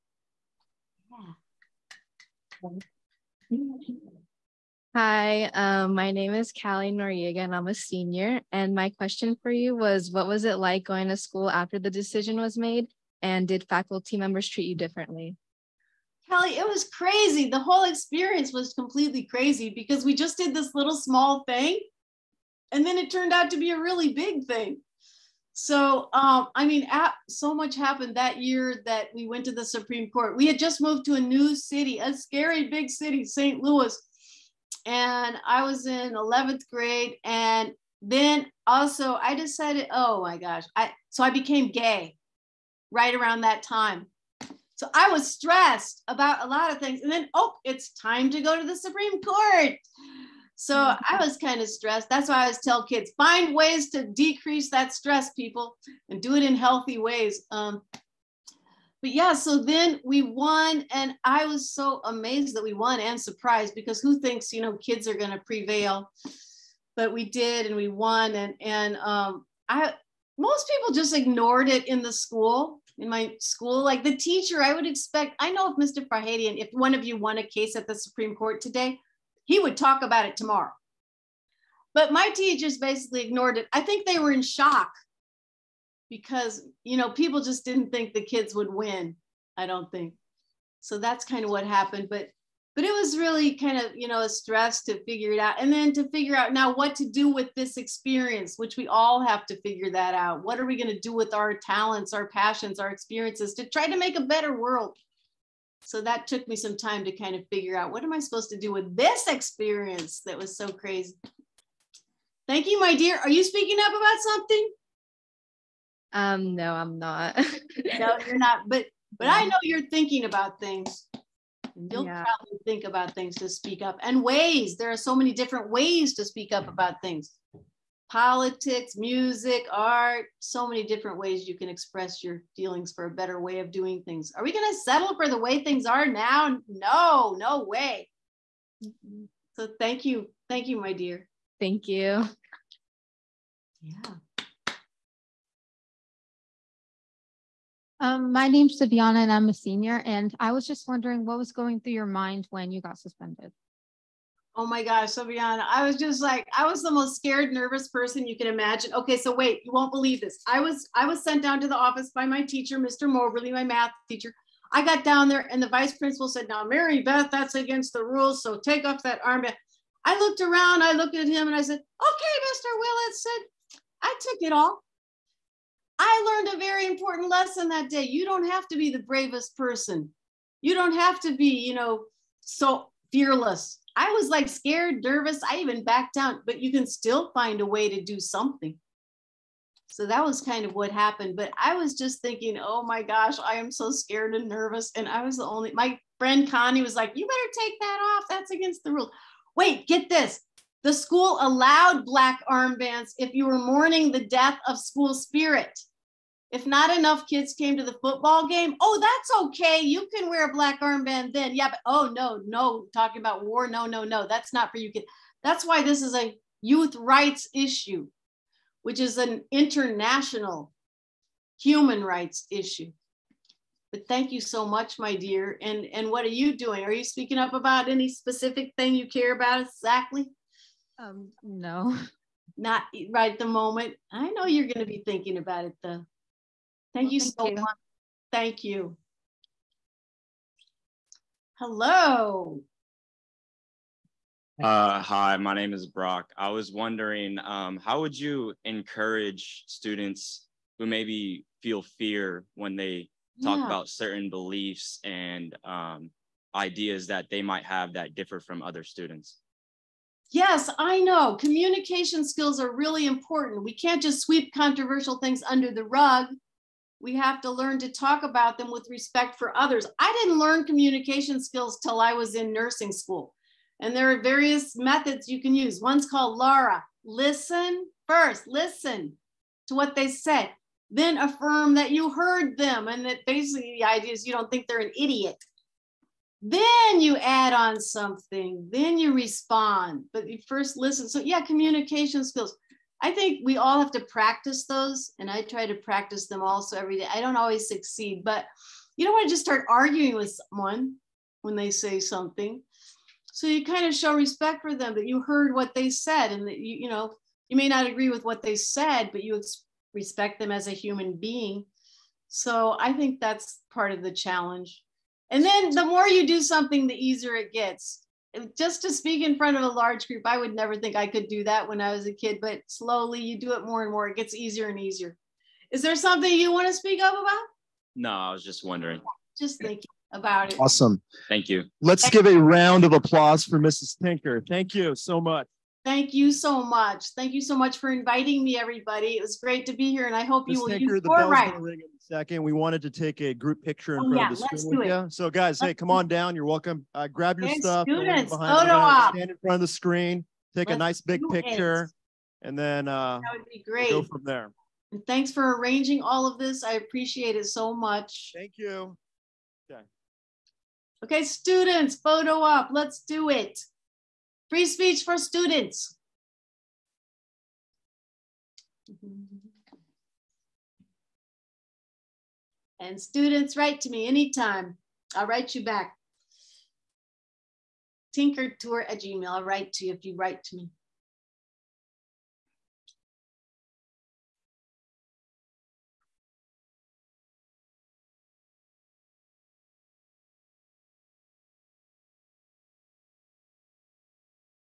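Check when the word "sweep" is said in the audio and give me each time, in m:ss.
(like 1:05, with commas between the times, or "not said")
4:24.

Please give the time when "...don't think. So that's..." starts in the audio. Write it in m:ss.
1:29.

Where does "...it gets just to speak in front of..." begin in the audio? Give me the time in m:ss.
5:17.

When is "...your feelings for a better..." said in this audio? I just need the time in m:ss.
2:12.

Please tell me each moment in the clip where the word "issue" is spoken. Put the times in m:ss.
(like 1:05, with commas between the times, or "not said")
3:37, 3:42.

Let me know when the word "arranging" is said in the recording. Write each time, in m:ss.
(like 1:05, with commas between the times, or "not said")
5:55.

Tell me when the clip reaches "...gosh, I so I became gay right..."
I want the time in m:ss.
0:40.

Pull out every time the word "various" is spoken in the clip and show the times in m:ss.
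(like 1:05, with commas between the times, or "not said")
4:34.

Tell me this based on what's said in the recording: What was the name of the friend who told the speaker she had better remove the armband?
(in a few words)
Connie.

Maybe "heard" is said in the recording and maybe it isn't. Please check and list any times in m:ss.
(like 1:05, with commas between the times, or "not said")
4:42, 5:05.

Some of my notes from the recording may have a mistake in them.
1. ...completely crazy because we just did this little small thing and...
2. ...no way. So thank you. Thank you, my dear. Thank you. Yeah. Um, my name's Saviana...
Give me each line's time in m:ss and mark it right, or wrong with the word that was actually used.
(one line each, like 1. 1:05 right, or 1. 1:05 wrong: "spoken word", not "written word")
1. 0:18 right
2. 2:17 right.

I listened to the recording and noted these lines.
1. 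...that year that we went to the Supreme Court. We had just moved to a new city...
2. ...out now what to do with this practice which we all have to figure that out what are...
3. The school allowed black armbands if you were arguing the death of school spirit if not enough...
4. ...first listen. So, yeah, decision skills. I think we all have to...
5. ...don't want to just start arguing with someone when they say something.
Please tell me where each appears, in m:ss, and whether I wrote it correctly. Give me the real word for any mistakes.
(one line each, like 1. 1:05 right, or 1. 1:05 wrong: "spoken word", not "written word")
1. 0:28 right
2. 1:36 wrong: "experience", not "practice"
3. 3:20 wrong: "mourning", not "arguing"
4. 4:50 wrong: "communication", not "decision"
5. 4:59 right.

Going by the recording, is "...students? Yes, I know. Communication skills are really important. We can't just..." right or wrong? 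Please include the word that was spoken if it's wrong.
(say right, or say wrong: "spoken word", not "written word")
right.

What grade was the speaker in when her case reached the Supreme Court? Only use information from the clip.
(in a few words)
11th grade.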